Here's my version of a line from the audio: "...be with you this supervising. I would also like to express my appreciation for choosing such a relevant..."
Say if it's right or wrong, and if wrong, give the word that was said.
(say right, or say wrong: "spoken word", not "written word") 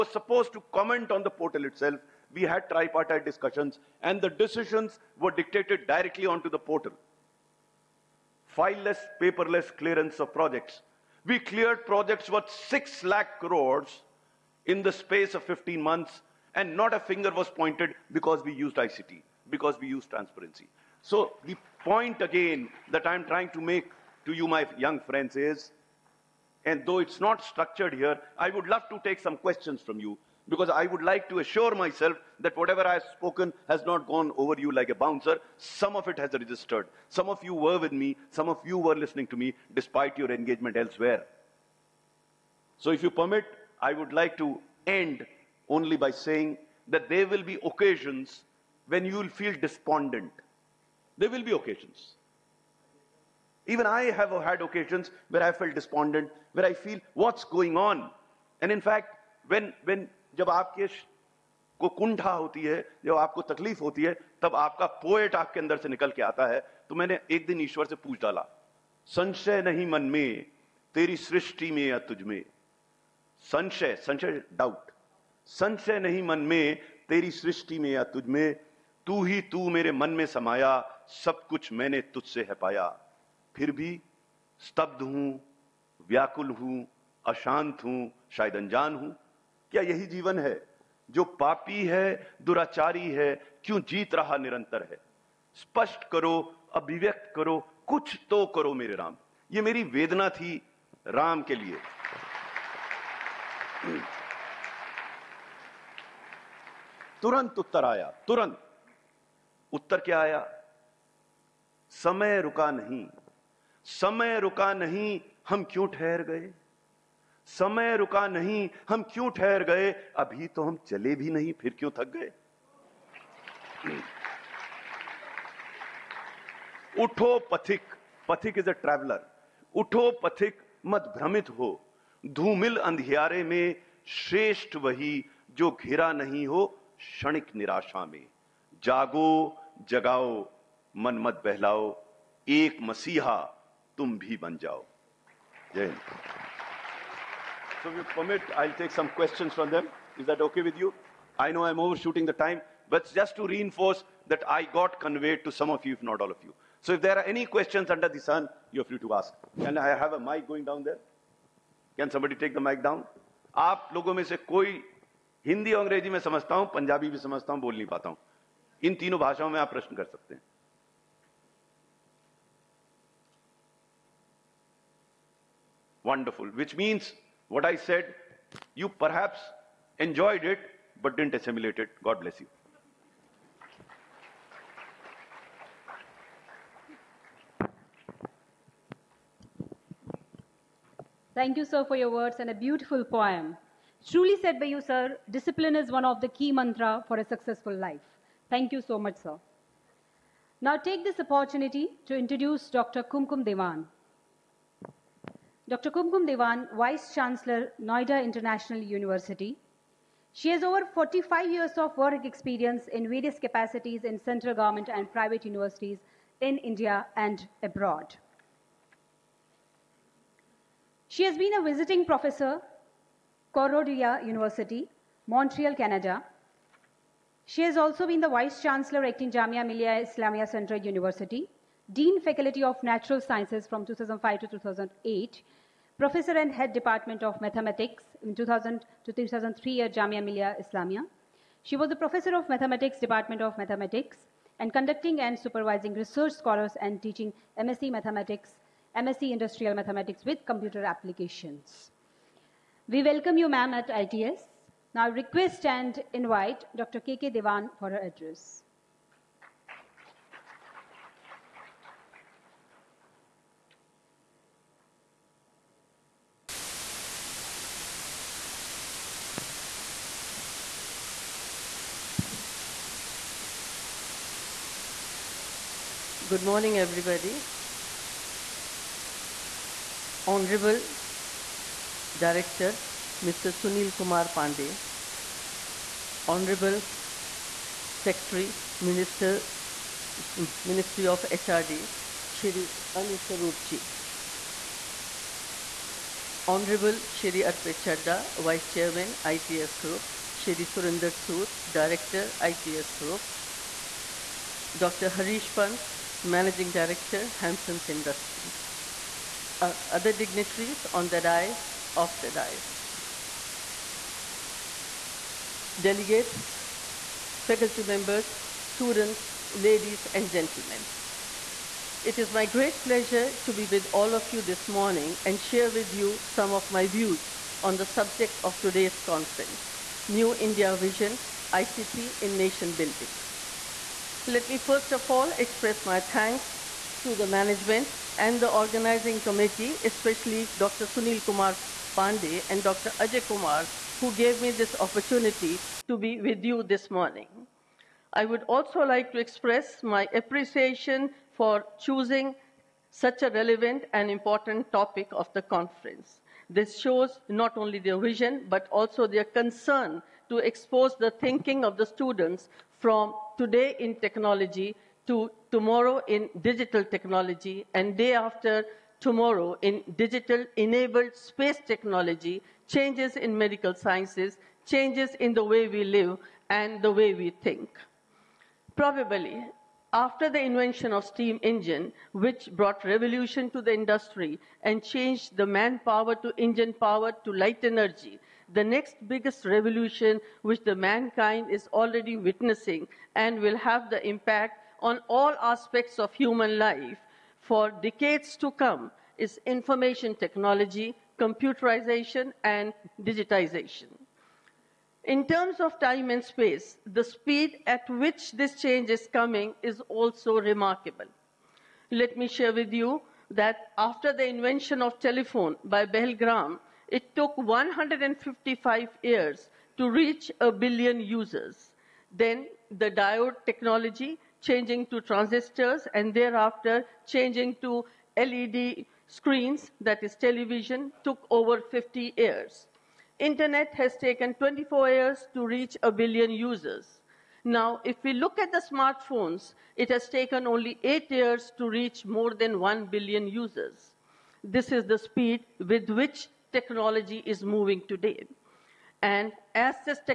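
wrong: "morning", not "supervising".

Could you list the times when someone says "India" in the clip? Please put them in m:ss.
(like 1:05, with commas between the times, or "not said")
3:36, 5:30.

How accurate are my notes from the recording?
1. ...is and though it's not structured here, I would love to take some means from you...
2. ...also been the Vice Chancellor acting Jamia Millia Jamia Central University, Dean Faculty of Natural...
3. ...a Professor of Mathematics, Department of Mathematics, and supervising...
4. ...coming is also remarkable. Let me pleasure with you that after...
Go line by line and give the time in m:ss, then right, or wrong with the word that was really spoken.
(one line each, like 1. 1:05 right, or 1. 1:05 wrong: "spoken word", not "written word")
1. 0:25 wrong: "questions", not "means"
2. 3:47 wrong: "Islamia", not "Jamia"
3. 4:01 wrong: "conducting", not "supervising"
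4. 6:49 wrong: "share", not "pleasure".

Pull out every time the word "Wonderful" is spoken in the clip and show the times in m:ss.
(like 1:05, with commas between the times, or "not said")
2:56.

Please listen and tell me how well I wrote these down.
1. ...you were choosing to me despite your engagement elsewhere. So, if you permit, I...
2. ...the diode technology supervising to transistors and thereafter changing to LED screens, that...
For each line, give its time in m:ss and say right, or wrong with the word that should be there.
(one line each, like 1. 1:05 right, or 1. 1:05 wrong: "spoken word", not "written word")
1. 0:38 wrong: "listening", not "choosing"
2. 7:02 wrong: "changing", not "supervising".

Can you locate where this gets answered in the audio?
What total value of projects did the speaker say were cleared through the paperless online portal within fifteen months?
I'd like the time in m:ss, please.
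0:12.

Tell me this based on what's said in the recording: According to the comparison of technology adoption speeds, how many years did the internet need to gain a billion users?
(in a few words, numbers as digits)
24.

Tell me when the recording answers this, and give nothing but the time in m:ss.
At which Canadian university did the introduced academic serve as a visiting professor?
3:43.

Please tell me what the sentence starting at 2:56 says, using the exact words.
Which means what I said, you perhaps enjoyed it but didn't assimilate it.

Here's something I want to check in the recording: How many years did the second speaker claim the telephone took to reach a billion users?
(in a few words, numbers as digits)
155.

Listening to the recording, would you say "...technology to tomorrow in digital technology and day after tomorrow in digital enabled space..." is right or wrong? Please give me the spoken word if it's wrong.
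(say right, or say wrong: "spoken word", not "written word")
right.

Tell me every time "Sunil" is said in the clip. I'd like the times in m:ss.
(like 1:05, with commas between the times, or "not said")
4:43, 5:40.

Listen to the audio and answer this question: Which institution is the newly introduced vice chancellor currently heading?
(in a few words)
Noida International University.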